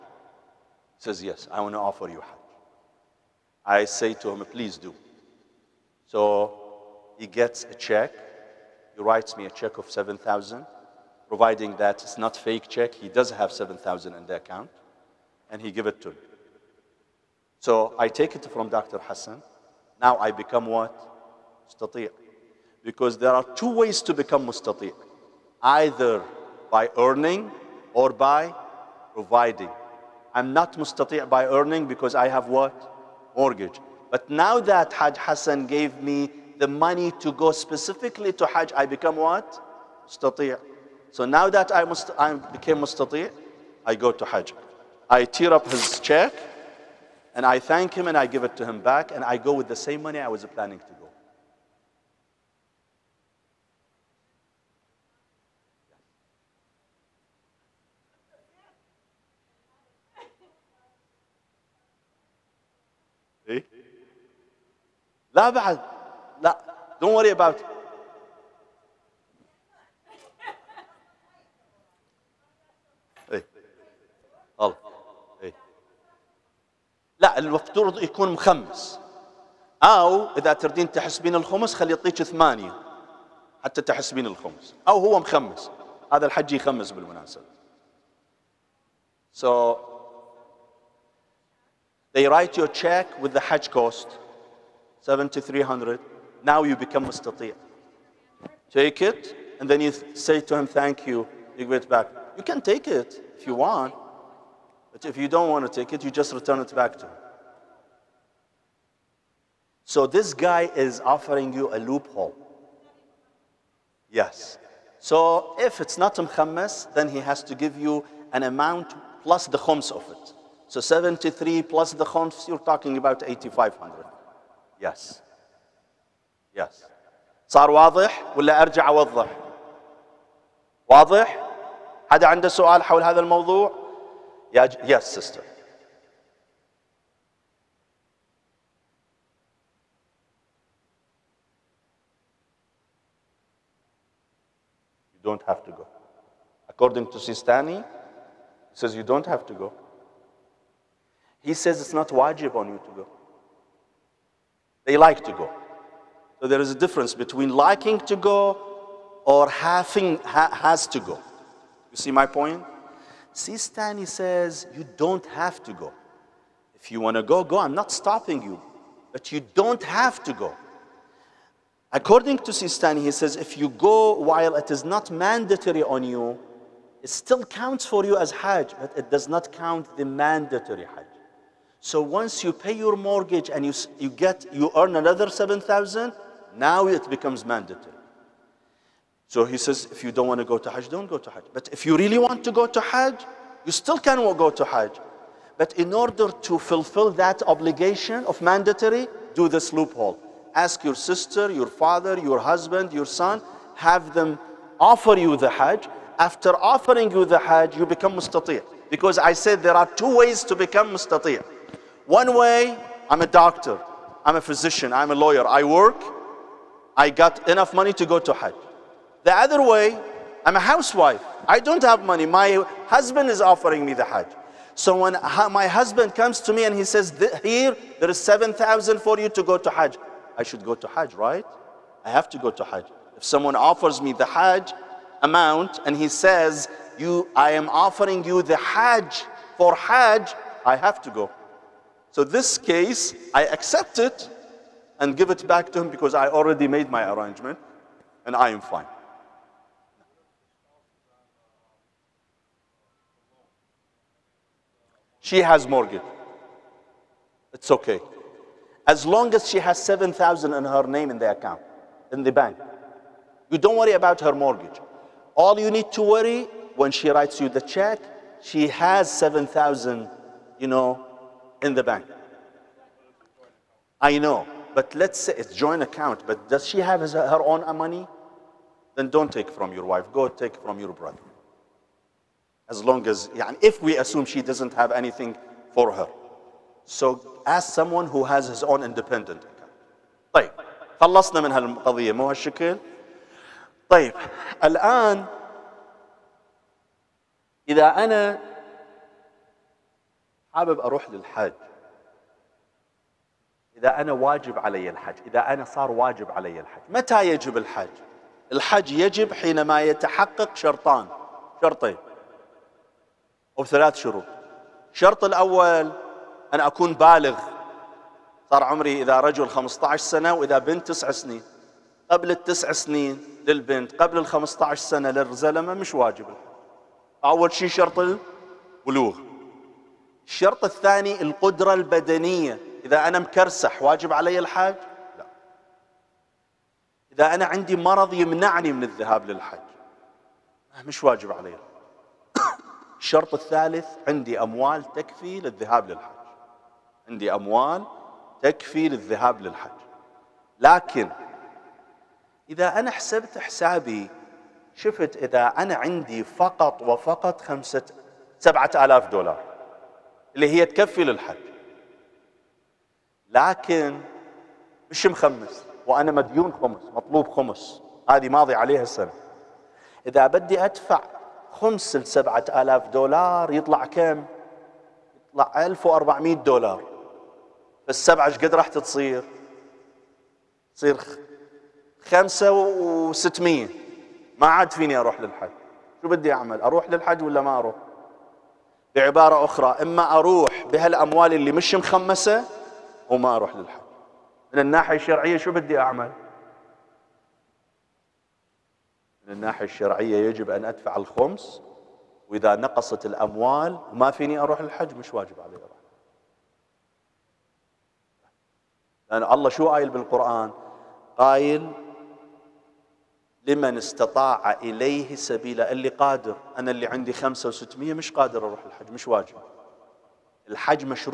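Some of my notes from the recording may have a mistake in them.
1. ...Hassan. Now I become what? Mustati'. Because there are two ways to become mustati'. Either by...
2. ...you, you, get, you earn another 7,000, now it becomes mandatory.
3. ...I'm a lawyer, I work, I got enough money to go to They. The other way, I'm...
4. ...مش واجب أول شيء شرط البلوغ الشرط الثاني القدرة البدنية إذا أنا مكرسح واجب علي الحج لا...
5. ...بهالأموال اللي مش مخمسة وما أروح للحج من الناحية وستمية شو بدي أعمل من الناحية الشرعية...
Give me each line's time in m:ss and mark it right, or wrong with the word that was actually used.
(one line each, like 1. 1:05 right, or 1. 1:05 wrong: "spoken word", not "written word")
1. 0:18 right
2. 3:03 right
3. 3:34 wrong: "Hajj", not "They"
4. 5:25 right
5. 6:30 wrong: "الشرعية", not "وستمية".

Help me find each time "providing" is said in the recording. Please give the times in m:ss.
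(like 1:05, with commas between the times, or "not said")
0:11, 0:29.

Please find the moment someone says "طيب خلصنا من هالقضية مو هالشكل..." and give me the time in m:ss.
4:50.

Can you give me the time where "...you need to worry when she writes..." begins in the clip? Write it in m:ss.
4:25.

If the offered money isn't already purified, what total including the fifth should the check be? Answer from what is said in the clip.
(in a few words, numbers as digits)
8,500.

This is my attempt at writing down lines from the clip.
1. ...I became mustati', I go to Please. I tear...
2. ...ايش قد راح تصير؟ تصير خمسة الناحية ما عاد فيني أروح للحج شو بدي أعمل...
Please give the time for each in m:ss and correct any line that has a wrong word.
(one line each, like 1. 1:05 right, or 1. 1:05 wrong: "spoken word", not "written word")
1. 0:42 wrong: "Hajj", not "Please"
2. 6:18 wrong: "وستمية", not "الناحية".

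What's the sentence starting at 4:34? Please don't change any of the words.
I know, but let's say it's joint account, but does she have her own money?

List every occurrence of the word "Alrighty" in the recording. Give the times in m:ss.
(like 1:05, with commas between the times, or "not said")
not said.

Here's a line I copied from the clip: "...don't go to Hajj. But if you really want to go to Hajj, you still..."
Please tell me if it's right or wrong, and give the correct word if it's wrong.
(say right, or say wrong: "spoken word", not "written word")
right.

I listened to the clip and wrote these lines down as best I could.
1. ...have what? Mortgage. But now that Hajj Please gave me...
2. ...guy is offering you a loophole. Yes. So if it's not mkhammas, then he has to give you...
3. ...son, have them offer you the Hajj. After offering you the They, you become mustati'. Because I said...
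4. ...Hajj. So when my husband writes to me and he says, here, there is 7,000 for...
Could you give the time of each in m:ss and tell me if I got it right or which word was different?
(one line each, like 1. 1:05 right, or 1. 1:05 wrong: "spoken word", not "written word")
1. 0:32 wrong: "Hassan", not "Please"
2. 1:50 right
3. 3:23 wrong: "Hajj", not "They"
4. 3:44 wrong: "comes", not "writes".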